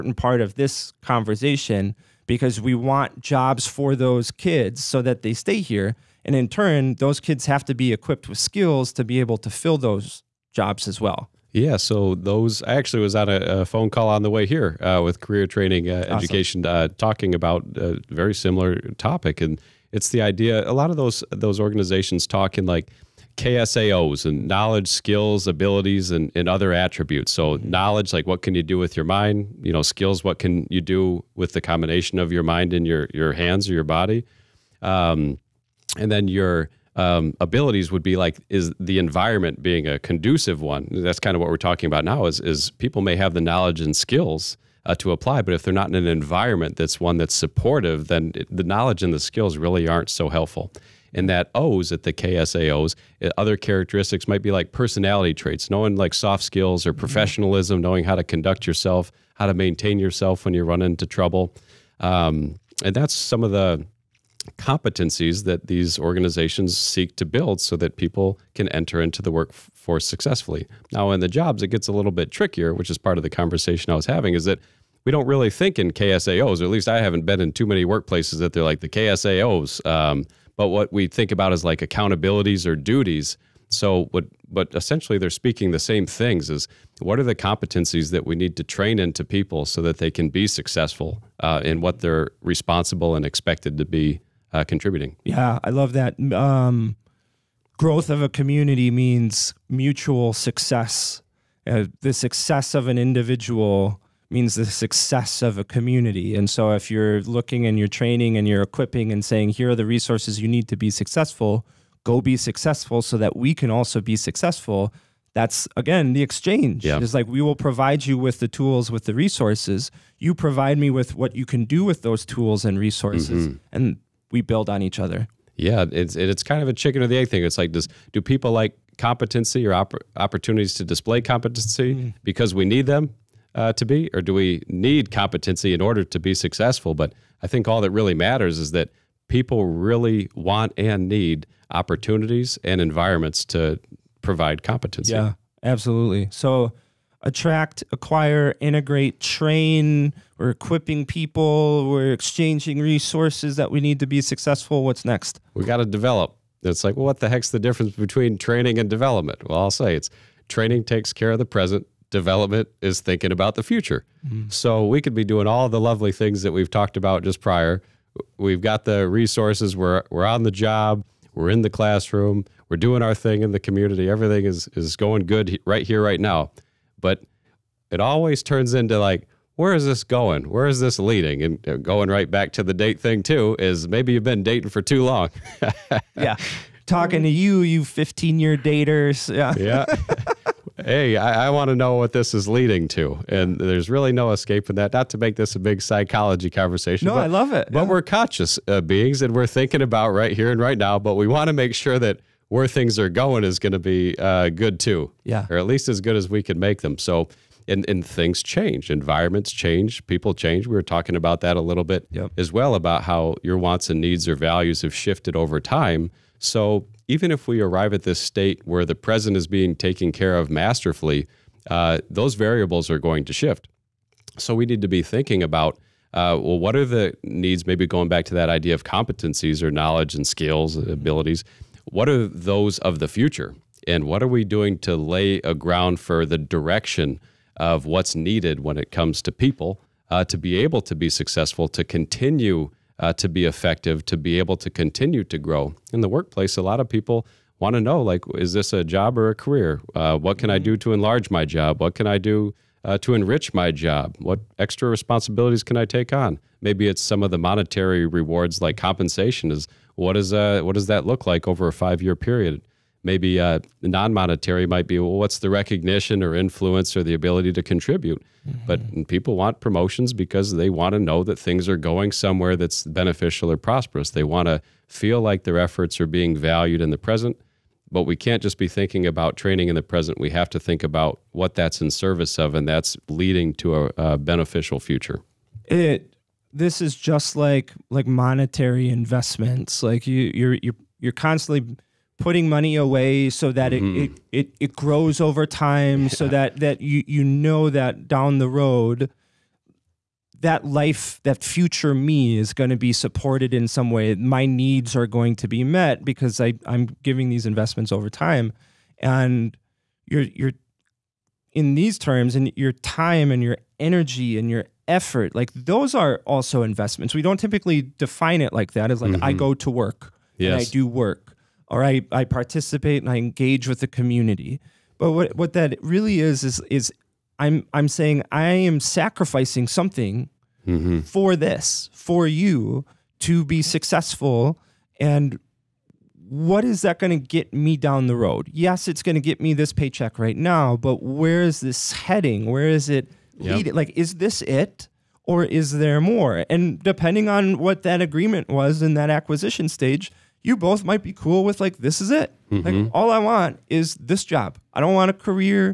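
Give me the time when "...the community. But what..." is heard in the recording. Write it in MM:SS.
05:23.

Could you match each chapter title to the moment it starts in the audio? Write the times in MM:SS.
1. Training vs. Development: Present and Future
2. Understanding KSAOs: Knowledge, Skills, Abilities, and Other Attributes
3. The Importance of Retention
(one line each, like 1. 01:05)
1. 02:34
2. 00:10
3. 04:05.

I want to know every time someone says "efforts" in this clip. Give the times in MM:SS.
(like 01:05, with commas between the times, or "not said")
04:35, 05:14.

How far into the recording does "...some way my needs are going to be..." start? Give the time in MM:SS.
05:03.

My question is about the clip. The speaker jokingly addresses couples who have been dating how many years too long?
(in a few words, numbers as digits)
15.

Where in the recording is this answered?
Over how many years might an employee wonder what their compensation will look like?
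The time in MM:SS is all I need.
04:21.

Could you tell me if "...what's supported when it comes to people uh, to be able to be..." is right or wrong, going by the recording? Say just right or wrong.
wrong.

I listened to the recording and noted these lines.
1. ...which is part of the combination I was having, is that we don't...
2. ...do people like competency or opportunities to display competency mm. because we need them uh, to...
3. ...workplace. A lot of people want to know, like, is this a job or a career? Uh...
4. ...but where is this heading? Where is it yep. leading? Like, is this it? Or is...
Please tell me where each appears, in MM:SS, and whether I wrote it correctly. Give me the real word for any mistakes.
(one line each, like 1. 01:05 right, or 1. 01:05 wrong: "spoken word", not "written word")
1. 01:12 wrong: "conversation", not "combination"
2. 02:08 right
3. 04:06 right
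4. 05:40 right.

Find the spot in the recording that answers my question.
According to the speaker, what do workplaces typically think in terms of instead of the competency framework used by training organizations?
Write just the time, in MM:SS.
01:21.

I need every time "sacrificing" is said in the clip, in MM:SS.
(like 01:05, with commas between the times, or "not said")
05:28.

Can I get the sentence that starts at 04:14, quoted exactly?
What extra responsibilities can I take on?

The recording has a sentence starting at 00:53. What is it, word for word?
Eh, other characteristics might be like personality traits, knowing like soft skills or mm-hmm.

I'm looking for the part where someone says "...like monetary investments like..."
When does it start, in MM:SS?
04:47.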